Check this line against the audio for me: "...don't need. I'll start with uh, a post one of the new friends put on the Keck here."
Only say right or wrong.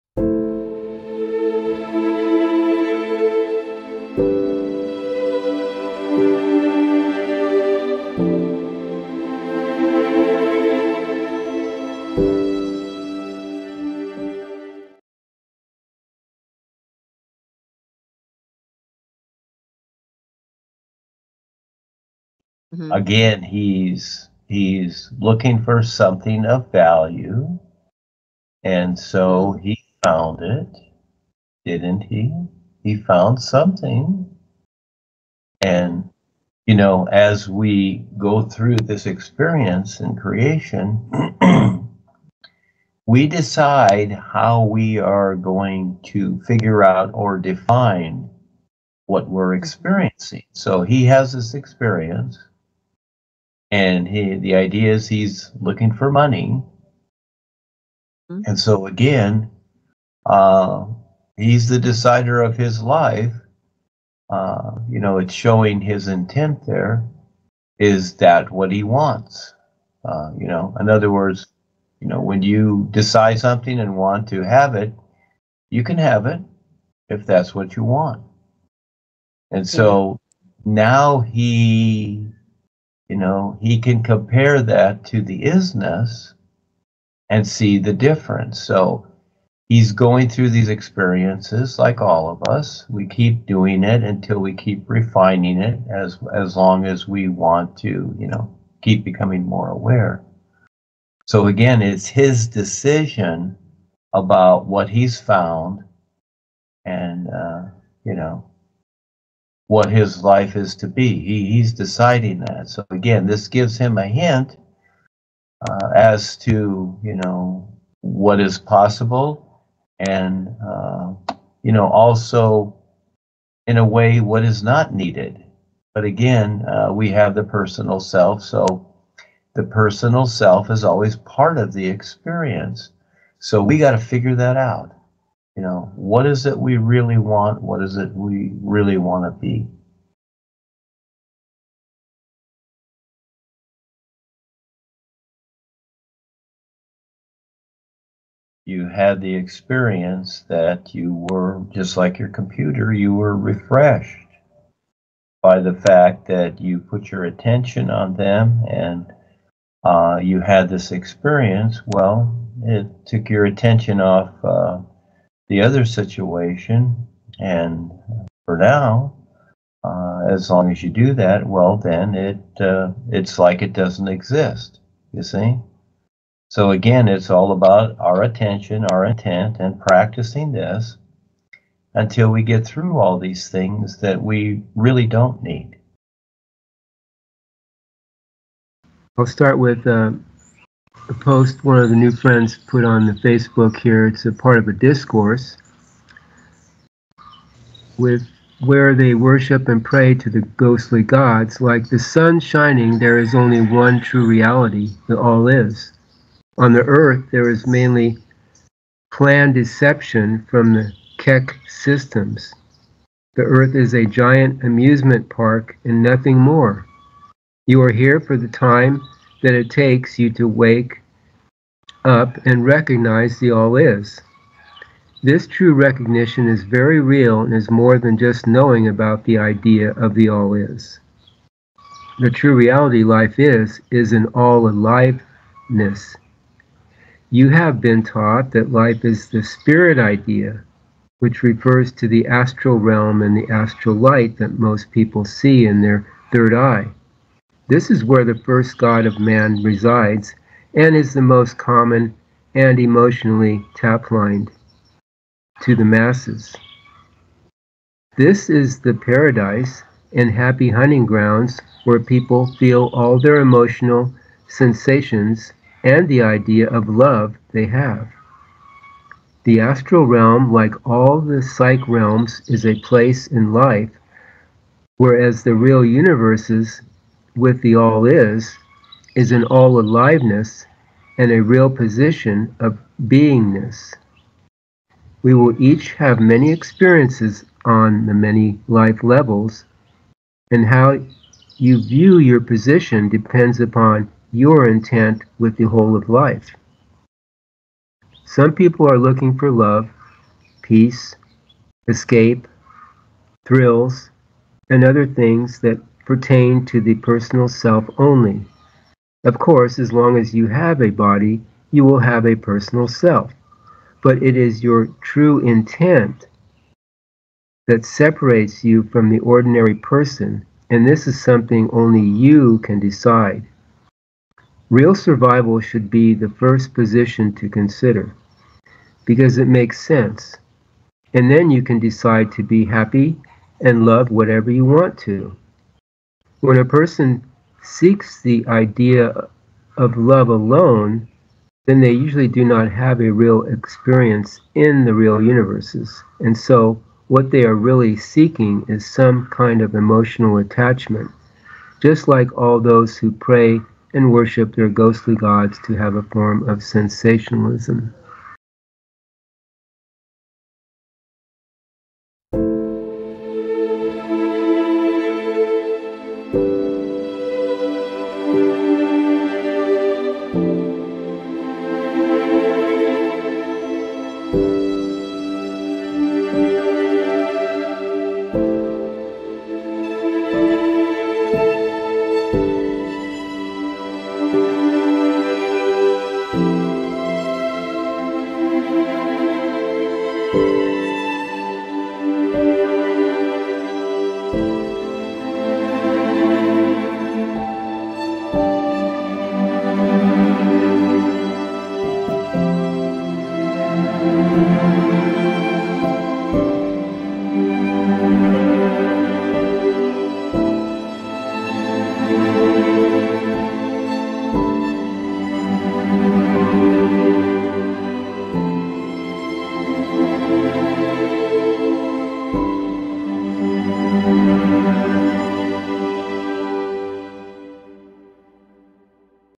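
wrong.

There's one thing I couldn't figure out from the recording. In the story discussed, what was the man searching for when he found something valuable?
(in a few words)
money.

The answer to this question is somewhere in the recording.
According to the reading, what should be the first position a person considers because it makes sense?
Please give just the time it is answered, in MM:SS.
05:24.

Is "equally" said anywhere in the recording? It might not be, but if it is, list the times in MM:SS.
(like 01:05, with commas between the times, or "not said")
not said.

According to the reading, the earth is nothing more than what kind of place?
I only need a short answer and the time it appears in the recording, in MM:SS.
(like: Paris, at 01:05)
A giant amusement park, at 03:34.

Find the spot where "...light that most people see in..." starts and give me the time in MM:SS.
04:03.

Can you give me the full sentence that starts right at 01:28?
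So he's going through these experiences like all of us.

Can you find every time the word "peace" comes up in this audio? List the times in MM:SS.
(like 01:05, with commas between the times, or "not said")
05:00.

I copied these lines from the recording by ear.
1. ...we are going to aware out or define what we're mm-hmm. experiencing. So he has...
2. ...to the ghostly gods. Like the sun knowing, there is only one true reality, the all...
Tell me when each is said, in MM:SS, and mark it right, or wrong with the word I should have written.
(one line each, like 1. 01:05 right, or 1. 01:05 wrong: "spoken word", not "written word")
1. 00:44 wrong: "figure", not "aware"
2. 03:20 wrong: "shining", not "knowing".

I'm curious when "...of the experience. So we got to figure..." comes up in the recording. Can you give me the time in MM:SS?
02:11.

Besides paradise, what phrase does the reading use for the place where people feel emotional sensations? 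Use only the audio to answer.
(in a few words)
happy hunting grounds.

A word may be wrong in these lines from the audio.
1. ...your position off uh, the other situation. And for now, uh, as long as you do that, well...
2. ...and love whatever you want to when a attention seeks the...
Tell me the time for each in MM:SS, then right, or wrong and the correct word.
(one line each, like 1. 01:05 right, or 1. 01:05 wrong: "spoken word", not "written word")
1. 02:43 wrong: "attention", not "position"
2. 05:33 wrong: "person", not "attention".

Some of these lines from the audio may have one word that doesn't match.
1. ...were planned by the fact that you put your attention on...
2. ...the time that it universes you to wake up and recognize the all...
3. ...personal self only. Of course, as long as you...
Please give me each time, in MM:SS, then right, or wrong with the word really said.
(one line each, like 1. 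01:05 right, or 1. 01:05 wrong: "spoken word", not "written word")
1. 02:33 wrong: "refreshed", not "planned"
2. 03:38 wrong: "takes", not "universes"
3. 05:06 right.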